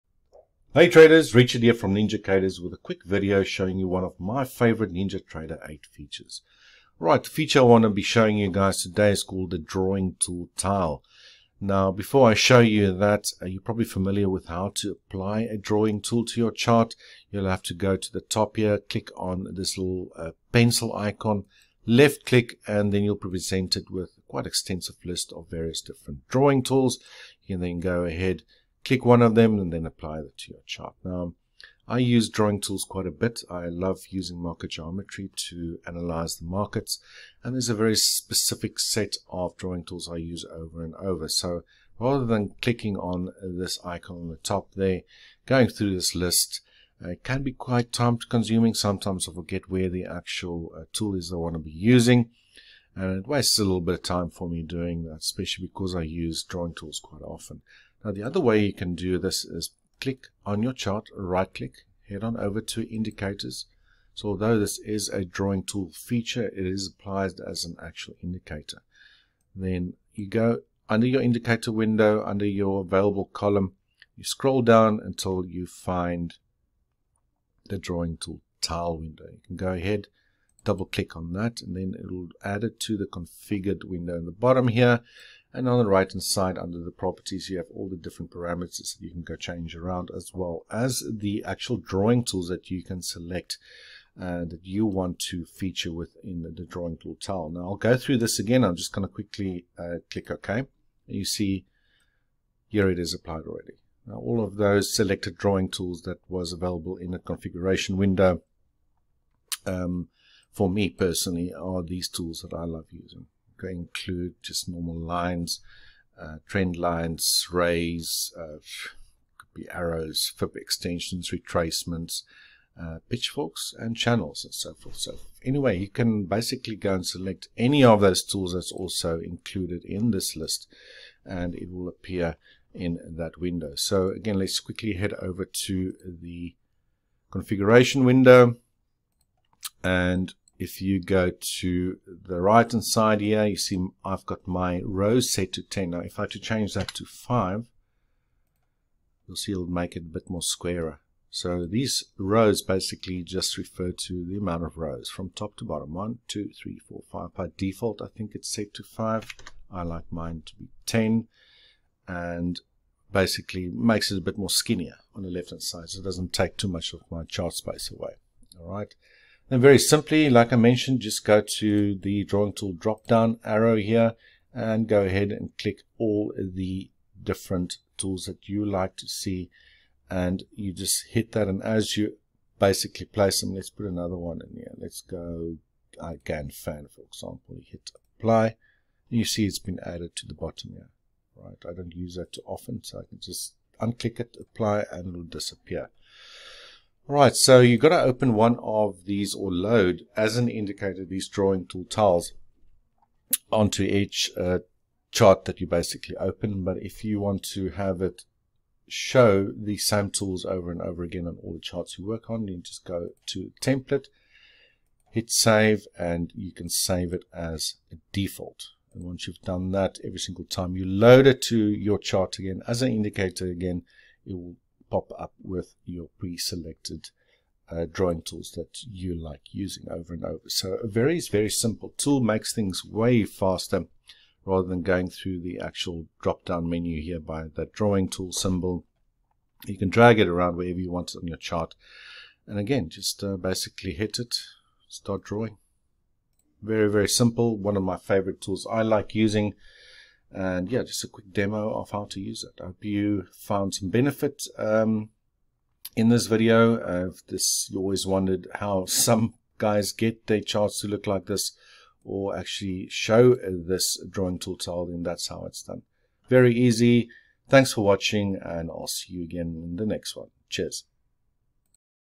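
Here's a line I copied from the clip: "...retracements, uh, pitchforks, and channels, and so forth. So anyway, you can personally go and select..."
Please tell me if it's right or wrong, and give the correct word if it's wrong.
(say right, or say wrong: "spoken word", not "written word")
wrong: "basically", not "personally".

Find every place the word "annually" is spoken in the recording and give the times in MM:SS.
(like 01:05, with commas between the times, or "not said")
not said.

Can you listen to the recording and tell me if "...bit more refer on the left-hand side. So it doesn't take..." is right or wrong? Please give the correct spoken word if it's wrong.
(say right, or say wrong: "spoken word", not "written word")
wrong: "skinnier", not "refer".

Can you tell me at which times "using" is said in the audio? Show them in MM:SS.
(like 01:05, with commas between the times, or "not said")
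00:34, 00:51, 01:52, 03:49, 04:09.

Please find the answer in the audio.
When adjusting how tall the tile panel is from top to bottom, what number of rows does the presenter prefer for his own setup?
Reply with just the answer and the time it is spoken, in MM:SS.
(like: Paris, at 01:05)
10, at 02:39.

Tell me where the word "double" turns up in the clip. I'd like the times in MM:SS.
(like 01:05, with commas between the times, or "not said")
01:20.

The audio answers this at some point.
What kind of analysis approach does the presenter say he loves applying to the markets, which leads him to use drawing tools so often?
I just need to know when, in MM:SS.
00:34.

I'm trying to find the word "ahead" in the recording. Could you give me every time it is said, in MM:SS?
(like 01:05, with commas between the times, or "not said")
00:28, 01:19, 02:55.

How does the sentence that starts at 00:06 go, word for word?
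Right, the feature I want to be showing you guys today is called the Drawing Tool Tile.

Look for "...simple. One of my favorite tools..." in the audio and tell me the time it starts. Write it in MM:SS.
04:07.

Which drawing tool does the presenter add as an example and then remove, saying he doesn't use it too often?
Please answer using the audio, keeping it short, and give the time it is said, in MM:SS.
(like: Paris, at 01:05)
Fan, at 03:06.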